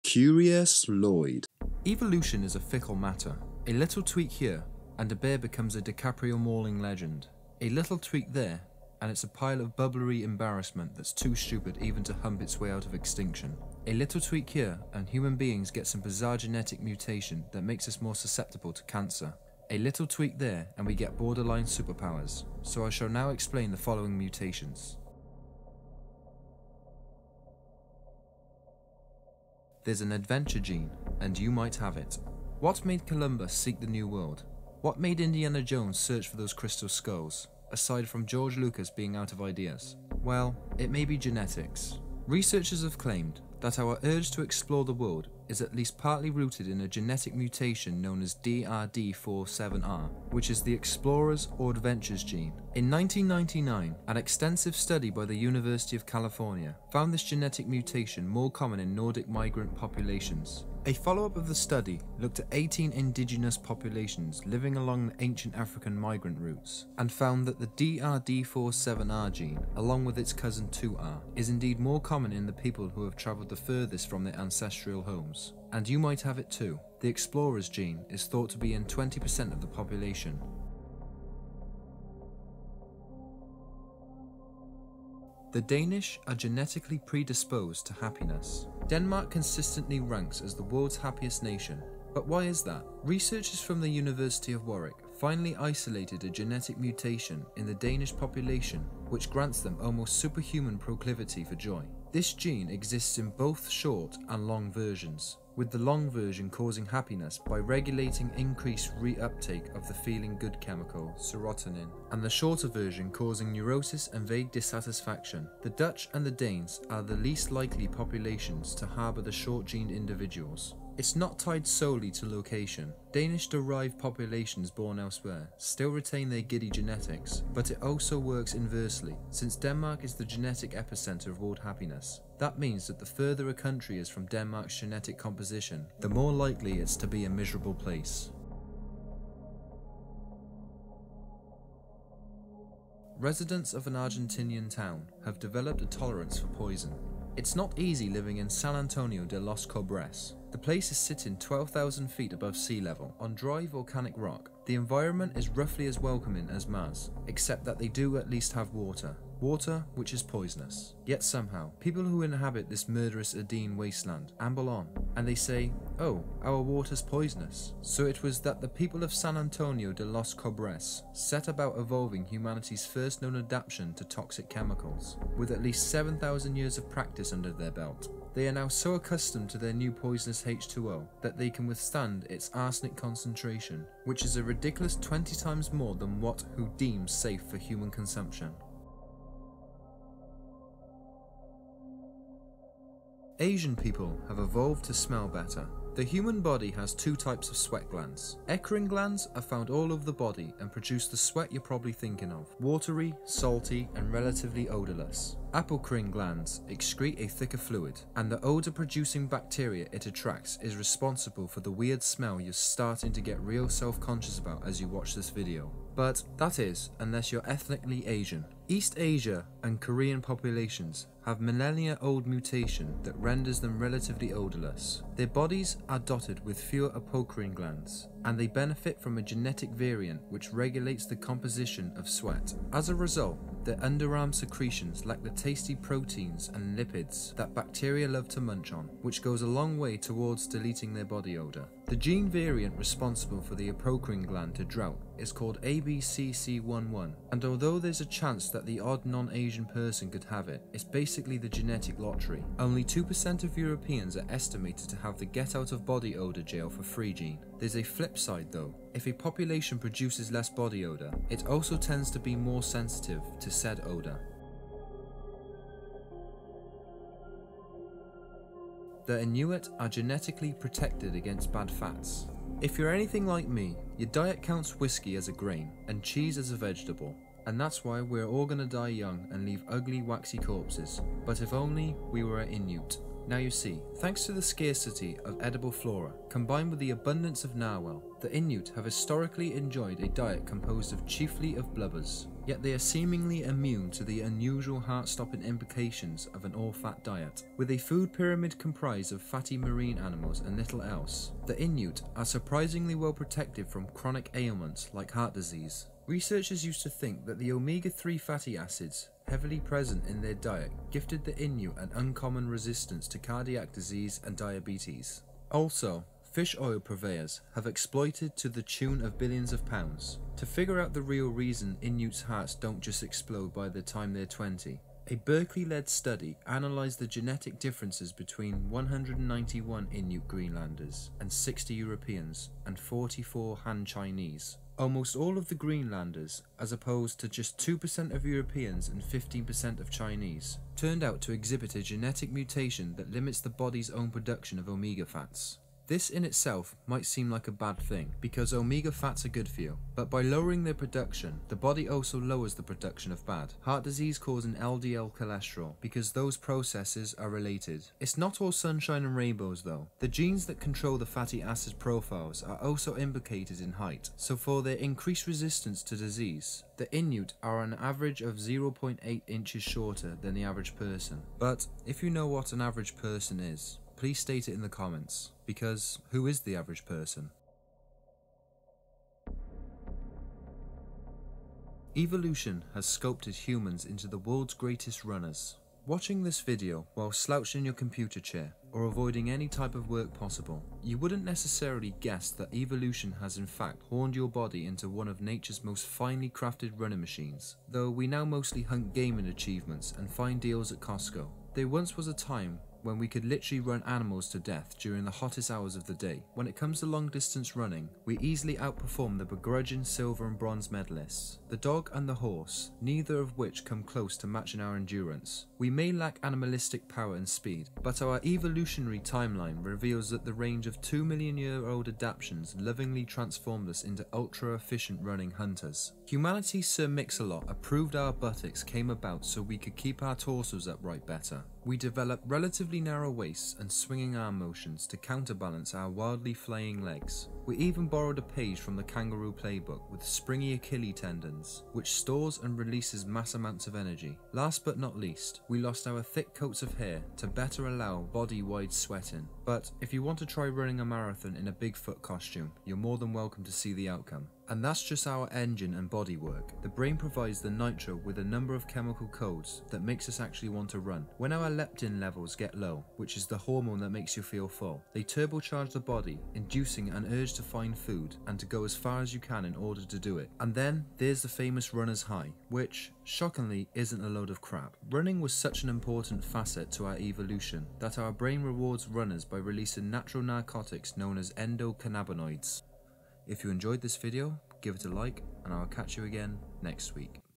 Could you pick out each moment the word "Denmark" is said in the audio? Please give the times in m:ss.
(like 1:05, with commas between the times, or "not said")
1:28, 2:09, 2:14.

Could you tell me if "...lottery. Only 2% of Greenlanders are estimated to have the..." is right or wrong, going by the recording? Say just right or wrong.
wrong.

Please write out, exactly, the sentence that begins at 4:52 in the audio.
Yet they are seemingly immune to the unusual heart-stopping implications of an all-fat diet.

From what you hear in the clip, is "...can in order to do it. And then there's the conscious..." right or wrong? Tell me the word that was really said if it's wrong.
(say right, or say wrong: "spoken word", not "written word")
wrong: "famous", not "conscious".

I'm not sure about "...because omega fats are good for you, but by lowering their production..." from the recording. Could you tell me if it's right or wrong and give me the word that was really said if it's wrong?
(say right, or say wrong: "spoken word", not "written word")
right.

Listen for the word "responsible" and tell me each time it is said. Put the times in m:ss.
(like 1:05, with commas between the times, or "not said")
3:30, 4:02.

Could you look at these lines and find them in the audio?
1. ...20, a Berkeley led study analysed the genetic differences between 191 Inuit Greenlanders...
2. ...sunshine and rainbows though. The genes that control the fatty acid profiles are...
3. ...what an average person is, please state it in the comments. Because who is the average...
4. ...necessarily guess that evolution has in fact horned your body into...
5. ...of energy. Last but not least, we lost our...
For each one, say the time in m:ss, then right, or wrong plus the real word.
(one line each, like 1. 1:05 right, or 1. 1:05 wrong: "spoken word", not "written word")
1. 5:24 right
2. 5:58 right
3. 6:12 right
4. 6:31 right
5. 7:23 right.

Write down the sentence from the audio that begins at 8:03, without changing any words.
If you enjoyed this video, give it a like and I'll catch you again next week.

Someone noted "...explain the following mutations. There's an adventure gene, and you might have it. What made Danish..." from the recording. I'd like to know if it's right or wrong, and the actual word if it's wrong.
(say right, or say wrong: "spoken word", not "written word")
wrong: "Columbus", not "Danish".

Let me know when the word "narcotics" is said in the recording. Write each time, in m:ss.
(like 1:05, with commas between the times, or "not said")
8:00.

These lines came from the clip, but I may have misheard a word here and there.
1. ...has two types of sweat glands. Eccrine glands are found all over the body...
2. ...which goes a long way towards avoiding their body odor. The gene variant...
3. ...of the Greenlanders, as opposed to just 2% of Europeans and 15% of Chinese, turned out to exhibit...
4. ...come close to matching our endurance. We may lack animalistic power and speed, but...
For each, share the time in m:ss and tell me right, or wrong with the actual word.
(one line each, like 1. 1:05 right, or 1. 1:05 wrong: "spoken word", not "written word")
1. 3:16 right
2. 3:59 wrong: "deleting", not "avoiding"
3. 5:35 right
4. 6:53 right.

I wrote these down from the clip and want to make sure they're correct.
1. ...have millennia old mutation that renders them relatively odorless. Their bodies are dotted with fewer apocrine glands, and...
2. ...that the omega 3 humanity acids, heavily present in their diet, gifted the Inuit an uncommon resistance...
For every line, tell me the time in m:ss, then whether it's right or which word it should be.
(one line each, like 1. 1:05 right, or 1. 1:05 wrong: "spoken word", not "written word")
1. 3:41 right
2. 5:07 wrong: "fatty", not "humanity".